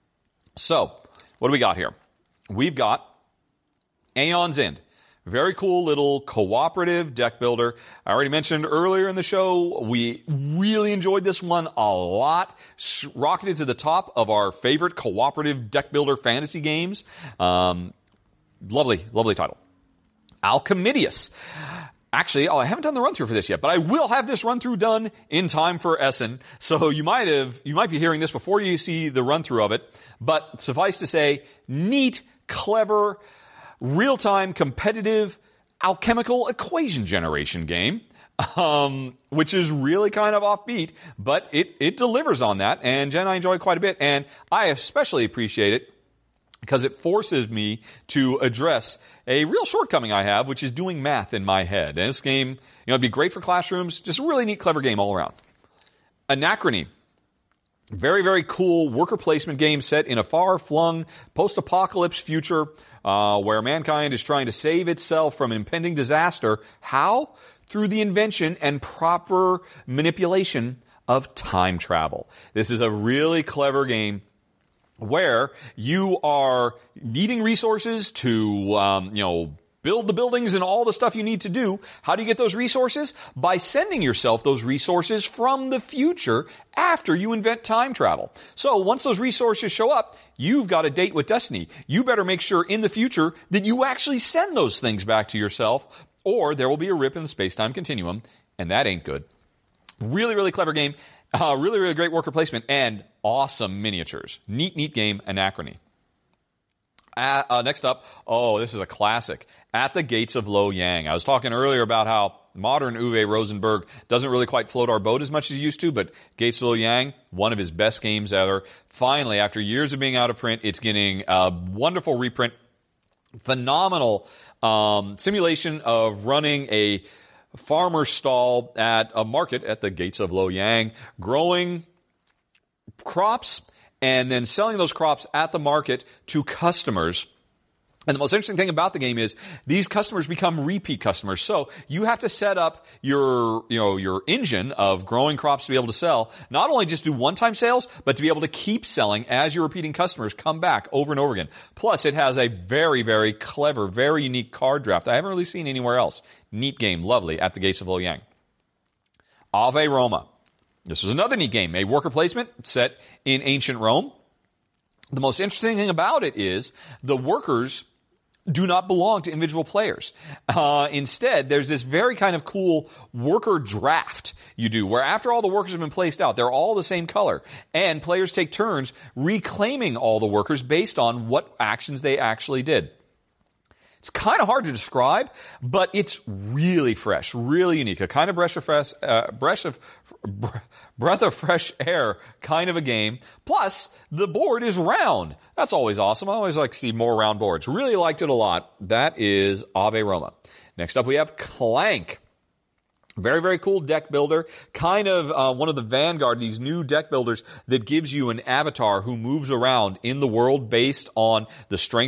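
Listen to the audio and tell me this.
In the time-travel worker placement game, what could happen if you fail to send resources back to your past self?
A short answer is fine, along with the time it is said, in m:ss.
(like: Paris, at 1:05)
A rip in the space-time continuum, at 1:36.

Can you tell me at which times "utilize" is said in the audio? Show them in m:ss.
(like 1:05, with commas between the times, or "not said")
not said.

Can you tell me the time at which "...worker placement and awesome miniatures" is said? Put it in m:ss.
1:42.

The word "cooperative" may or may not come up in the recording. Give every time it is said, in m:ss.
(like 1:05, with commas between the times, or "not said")
0:06, 0:14.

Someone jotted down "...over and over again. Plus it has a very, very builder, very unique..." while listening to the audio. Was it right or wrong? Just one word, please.
wrong.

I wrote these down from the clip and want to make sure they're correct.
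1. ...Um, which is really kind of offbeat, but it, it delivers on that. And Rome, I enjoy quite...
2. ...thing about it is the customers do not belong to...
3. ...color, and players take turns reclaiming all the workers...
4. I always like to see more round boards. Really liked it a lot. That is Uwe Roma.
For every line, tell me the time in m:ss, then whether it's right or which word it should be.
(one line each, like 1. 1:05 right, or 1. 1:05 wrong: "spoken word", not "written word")
1. 0:38 wrong: "Jen", not "Rome"
2. 2:45 wrong: "workers", not "customers"
3. 2:57 right
4. 3:16 wrong: "Ave", not "Uwe".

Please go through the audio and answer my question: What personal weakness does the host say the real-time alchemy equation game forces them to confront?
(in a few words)
Doing math in my head.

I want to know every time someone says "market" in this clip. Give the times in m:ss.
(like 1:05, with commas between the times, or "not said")
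2:09, 2:15.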